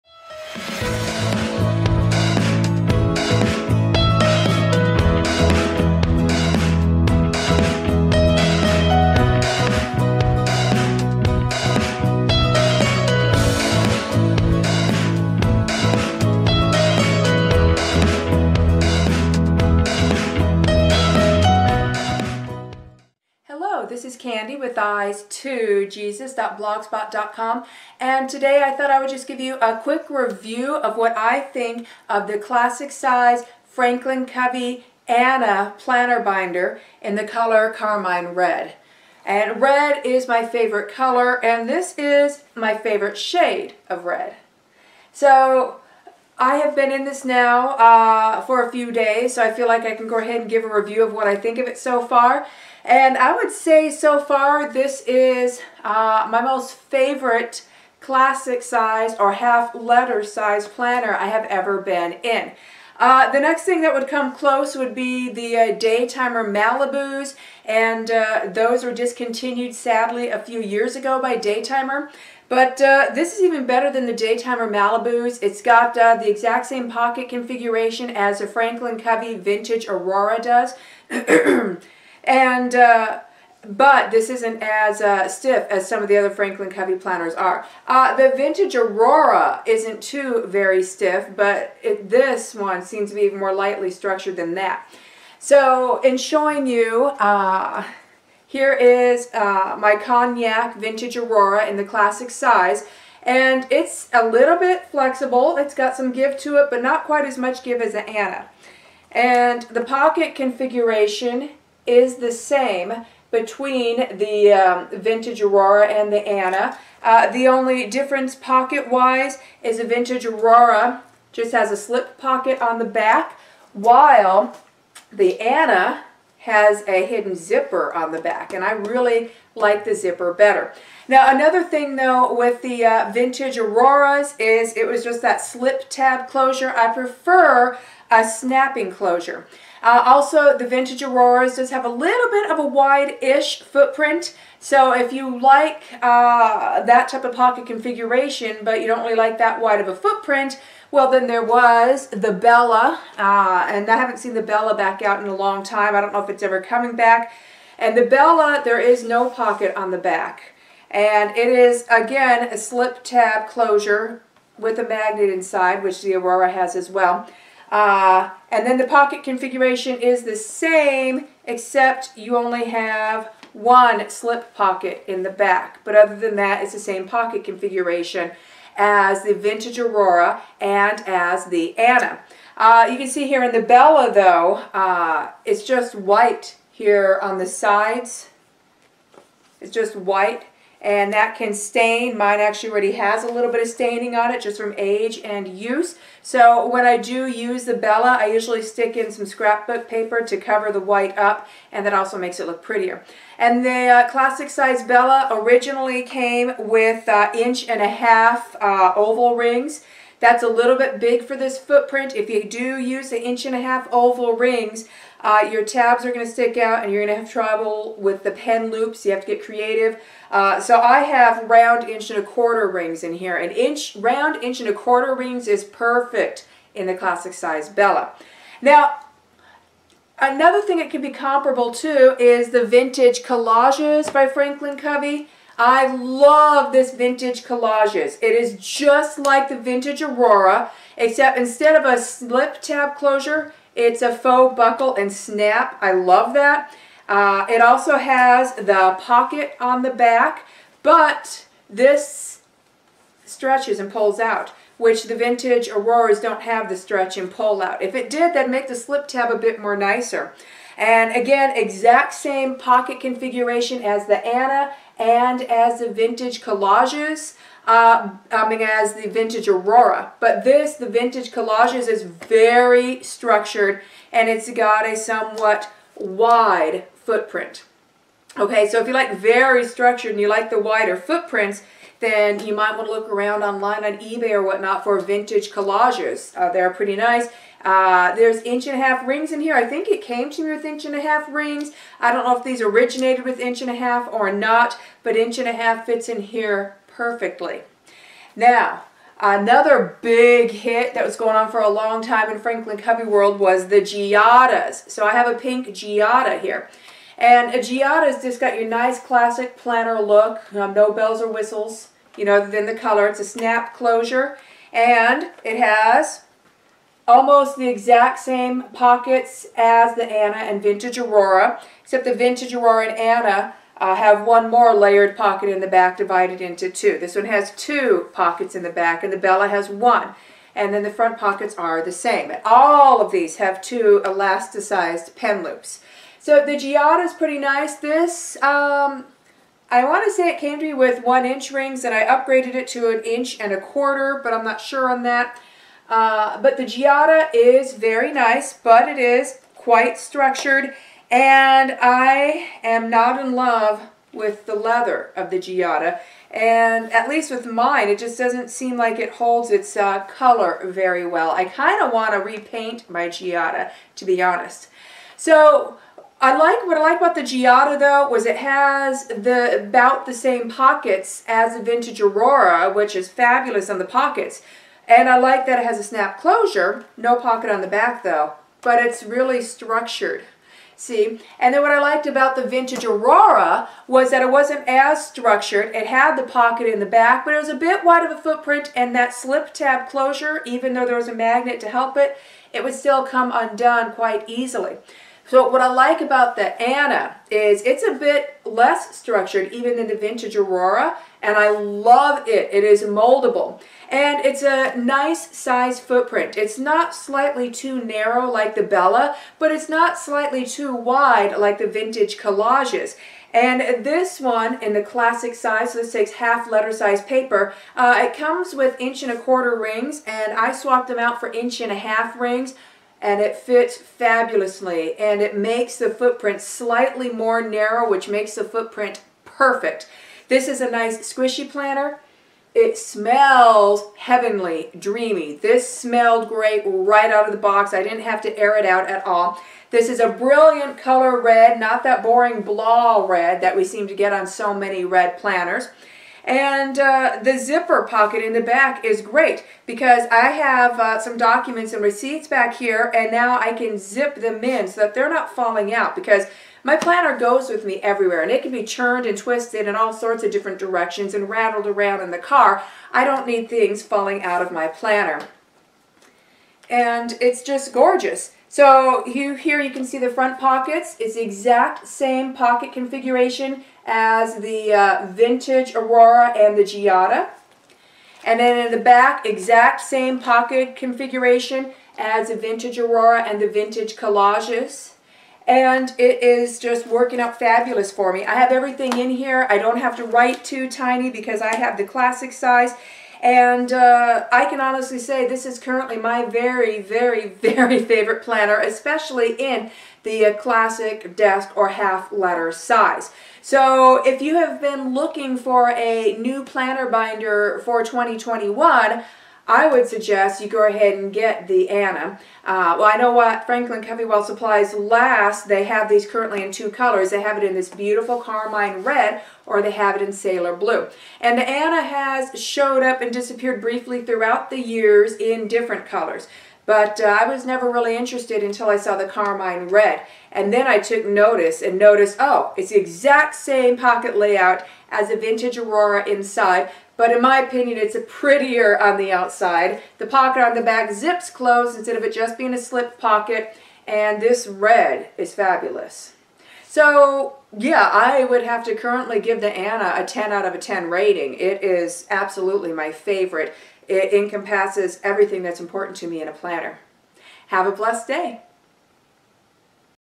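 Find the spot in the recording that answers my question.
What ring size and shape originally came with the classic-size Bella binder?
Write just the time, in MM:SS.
03:27.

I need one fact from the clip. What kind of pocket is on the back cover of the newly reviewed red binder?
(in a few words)
hidden zipper.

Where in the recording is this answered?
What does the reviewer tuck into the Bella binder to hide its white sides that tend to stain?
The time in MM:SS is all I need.
03:19.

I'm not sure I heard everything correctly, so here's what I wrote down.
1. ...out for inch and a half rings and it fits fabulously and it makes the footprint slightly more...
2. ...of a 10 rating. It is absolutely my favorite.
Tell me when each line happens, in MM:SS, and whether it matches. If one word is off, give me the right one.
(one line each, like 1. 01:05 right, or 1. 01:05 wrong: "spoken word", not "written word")
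1. 07:00 right
2. 09:10 right.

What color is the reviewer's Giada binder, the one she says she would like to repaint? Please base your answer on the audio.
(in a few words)
pink.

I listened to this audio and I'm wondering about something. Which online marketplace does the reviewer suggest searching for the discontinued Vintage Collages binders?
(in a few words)
eBay.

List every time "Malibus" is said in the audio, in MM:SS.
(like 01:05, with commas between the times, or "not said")
01:06, 01:14.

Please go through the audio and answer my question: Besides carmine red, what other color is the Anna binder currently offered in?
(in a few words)
sailor blue.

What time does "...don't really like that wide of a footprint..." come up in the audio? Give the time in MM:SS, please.
02:28.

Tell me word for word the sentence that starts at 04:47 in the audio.
Uh, there's inch and a half rings in here.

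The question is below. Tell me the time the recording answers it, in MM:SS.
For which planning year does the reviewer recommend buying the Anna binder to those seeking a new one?
08:27.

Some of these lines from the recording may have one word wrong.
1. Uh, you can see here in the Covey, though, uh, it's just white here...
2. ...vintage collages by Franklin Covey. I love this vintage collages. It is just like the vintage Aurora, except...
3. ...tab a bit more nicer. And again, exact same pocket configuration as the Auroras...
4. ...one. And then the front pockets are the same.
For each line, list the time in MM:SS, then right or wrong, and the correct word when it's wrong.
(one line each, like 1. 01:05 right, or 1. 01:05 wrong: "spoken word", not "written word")
1. 03:02 wrong: "Bella", not "Covey"
2. 03:52 right
3. 04:19 wrong: "Anna", not "Auroras"
4. 05:29 right.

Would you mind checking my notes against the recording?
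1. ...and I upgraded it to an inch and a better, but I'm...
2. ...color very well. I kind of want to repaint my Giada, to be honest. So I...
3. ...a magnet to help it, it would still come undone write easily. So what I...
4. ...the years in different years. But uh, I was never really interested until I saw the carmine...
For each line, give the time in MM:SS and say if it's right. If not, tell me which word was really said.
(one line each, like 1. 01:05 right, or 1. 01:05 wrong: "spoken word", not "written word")
1. 05:41 wrong: "quarter", not "better"
2. 06:00 right
3. 06:31 wrong: "quite", not "write"
4. 08:44 wrong: "colors", not "years".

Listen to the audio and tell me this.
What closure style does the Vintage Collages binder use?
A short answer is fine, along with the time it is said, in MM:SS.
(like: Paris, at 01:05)
faux buckle and snap, at 04:04.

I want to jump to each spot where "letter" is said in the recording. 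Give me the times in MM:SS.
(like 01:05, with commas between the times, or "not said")
00:59, 06:56, 08:22.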